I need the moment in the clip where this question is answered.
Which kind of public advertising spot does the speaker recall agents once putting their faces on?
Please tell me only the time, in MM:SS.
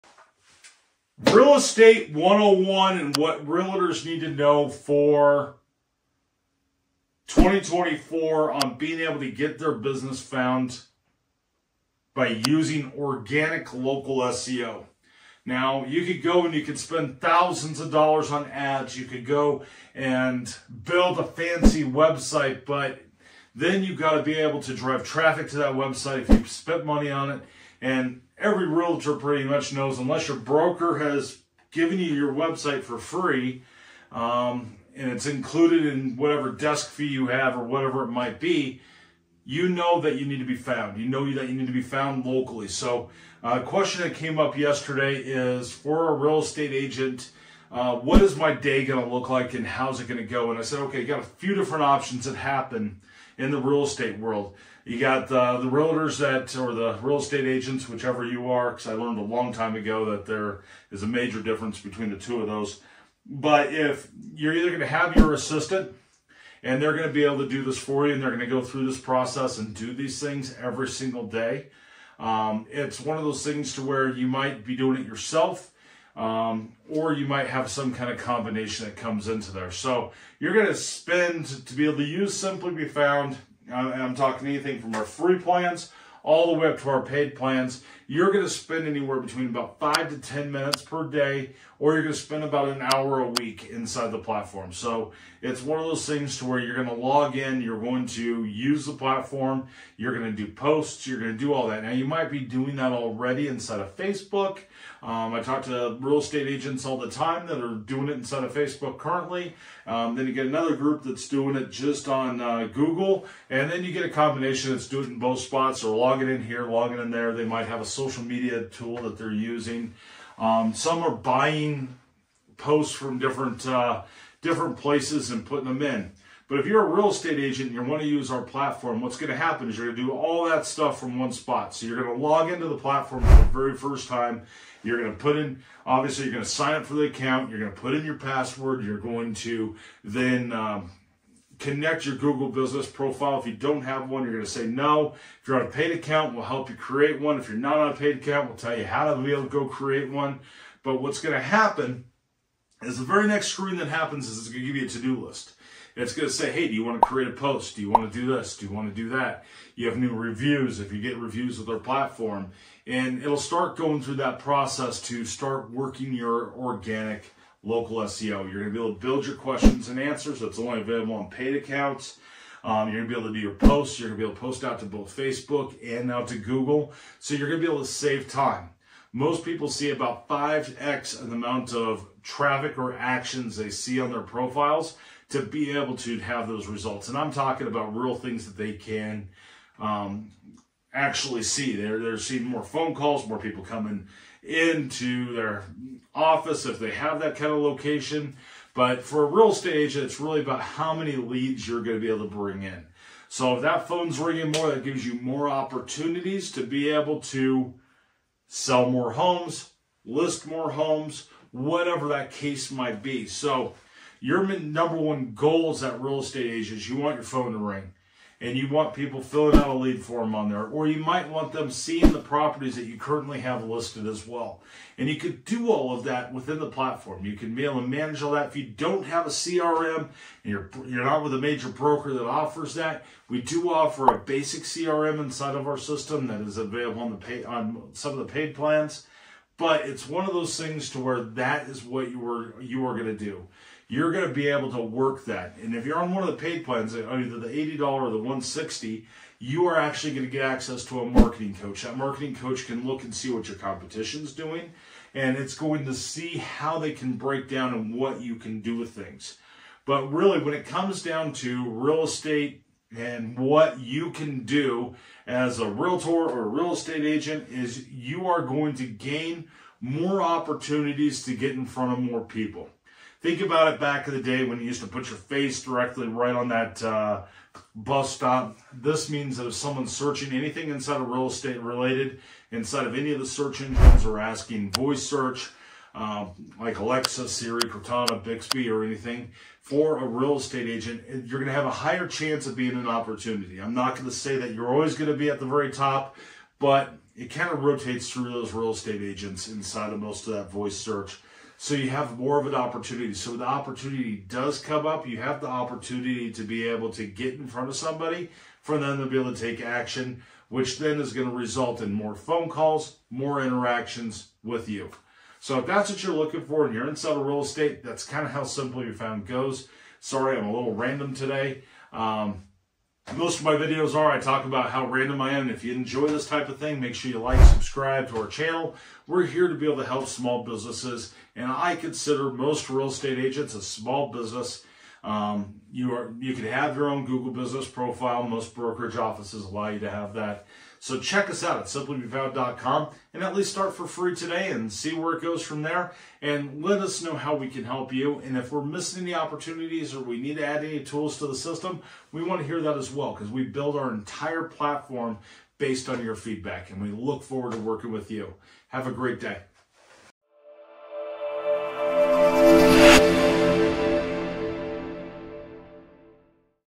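04:37.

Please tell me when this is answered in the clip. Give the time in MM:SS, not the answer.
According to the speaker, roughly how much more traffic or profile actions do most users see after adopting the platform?
03:00.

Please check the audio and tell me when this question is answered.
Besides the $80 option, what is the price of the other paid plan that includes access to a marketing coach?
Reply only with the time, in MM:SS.
04:08.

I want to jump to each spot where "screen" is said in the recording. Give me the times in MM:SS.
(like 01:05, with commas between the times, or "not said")
02:33.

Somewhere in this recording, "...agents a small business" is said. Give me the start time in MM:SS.
05:33.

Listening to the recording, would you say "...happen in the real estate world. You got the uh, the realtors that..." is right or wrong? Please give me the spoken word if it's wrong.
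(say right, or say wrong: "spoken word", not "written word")
right.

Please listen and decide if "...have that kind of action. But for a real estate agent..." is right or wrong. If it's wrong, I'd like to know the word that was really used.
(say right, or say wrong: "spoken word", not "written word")
wrong: "location", not "action".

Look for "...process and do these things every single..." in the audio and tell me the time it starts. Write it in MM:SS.
01:08.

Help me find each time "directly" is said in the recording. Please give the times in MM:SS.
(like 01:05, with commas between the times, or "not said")
04:35.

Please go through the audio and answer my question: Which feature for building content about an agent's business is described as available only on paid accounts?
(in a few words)
questions and answers.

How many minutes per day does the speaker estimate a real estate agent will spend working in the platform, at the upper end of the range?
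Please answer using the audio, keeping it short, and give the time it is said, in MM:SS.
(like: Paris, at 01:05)
10 minutes, at 01:30.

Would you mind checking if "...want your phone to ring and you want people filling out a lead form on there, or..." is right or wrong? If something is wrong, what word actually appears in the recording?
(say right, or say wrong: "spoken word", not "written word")
right.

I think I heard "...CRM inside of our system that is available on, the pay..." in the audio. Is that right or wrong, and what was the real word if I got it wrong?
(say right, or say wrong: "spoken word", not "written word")
right.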